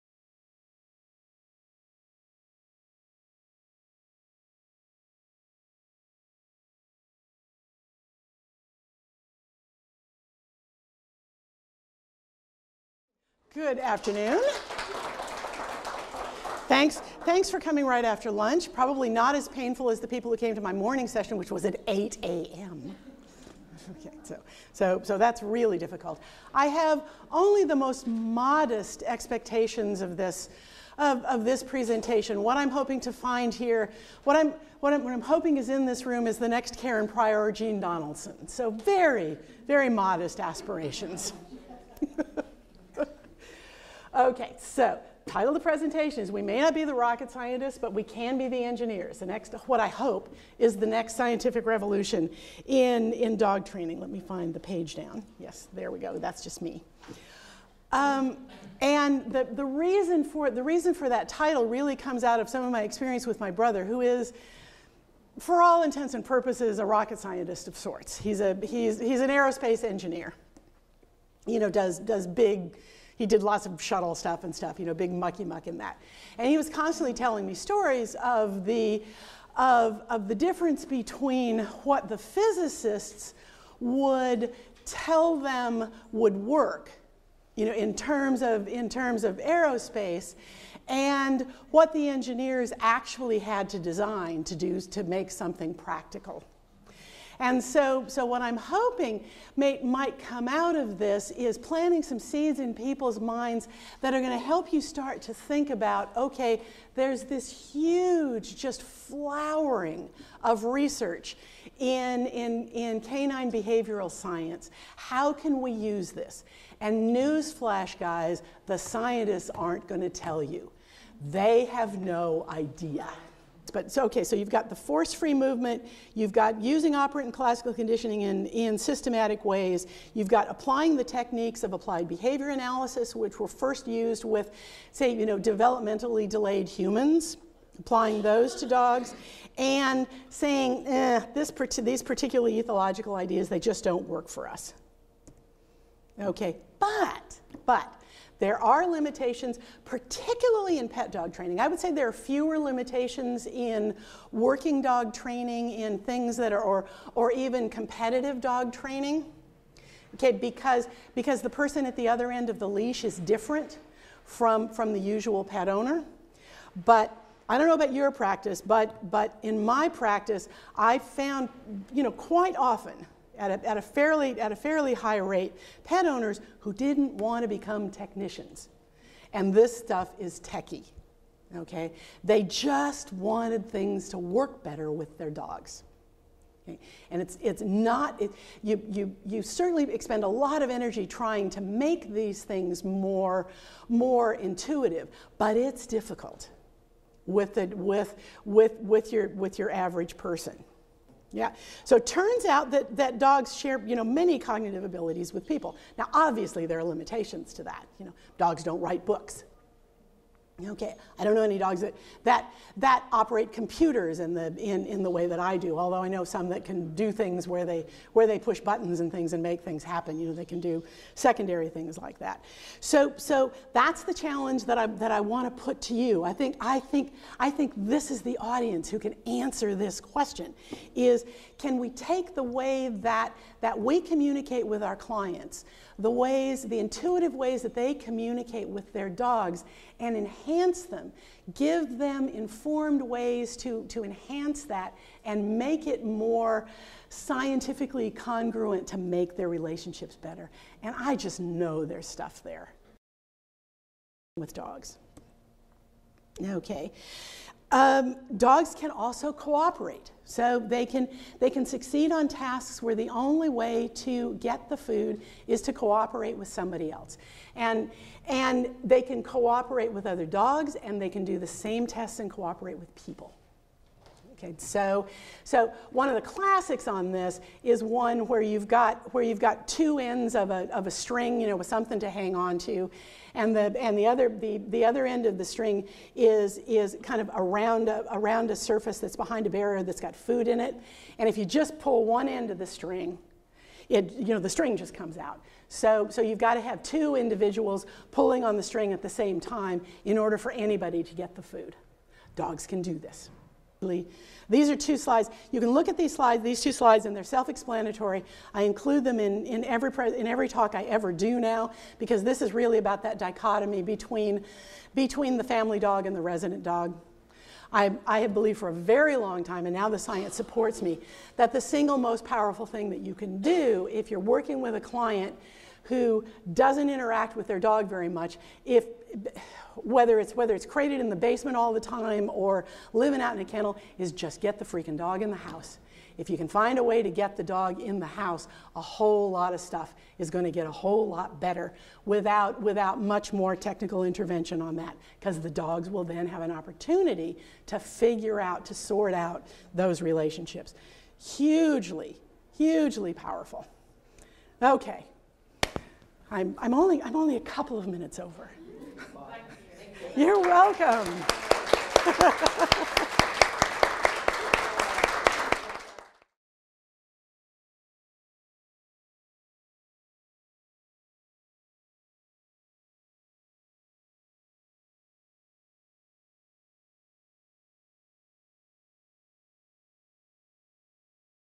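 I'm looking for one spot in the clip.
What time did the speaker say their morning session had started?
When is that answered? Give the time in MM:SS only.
00:21.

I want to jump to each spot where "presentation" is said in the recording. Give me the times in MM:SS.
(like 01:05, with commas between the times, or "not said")
00:31, 00:45.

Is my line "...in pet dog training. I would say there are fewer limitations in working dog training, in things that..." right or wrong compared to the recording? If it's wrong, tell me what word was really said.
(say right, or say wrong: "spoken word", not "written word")
right.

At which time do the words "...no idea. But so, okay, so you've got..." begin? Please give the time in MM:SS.
02:02.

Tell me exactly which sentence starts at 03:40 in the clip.
You know, they can do secondary things like that.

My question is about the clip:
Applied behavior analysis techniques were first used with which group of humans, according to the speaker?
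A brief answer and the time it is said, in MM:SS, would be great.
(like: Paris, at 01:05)
Developmentally delayed humans, at 02:15.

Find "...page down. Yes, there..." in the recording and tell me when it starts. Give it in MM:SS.
00:54.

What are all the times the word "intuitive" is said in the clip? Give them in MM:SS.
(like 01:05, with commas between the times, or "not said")
03:14, 03:56.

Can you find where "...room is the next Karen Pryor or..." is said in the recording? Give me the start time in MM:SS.
00:36.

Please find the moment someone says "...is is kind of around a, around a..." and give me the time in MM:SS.
04:46.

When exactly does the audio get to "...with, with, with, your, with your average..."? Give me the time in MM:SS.
03:17.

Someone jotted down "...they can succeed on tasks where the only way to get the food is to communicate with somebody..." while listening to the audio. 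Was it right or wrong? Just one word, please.
wrong.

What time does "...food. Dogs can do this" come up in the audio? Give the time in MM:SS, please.
05:01.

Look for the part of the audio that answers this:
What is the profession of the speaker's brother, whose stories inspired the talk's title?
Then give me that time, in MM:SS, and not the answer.
01:09.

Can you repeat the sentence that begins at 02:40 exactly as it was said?
Okay, because, because the person at the other end of the leash is different from, from the usual pet owner.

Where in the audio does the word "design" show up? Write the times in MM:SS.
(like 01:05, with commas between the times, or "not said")
01:33.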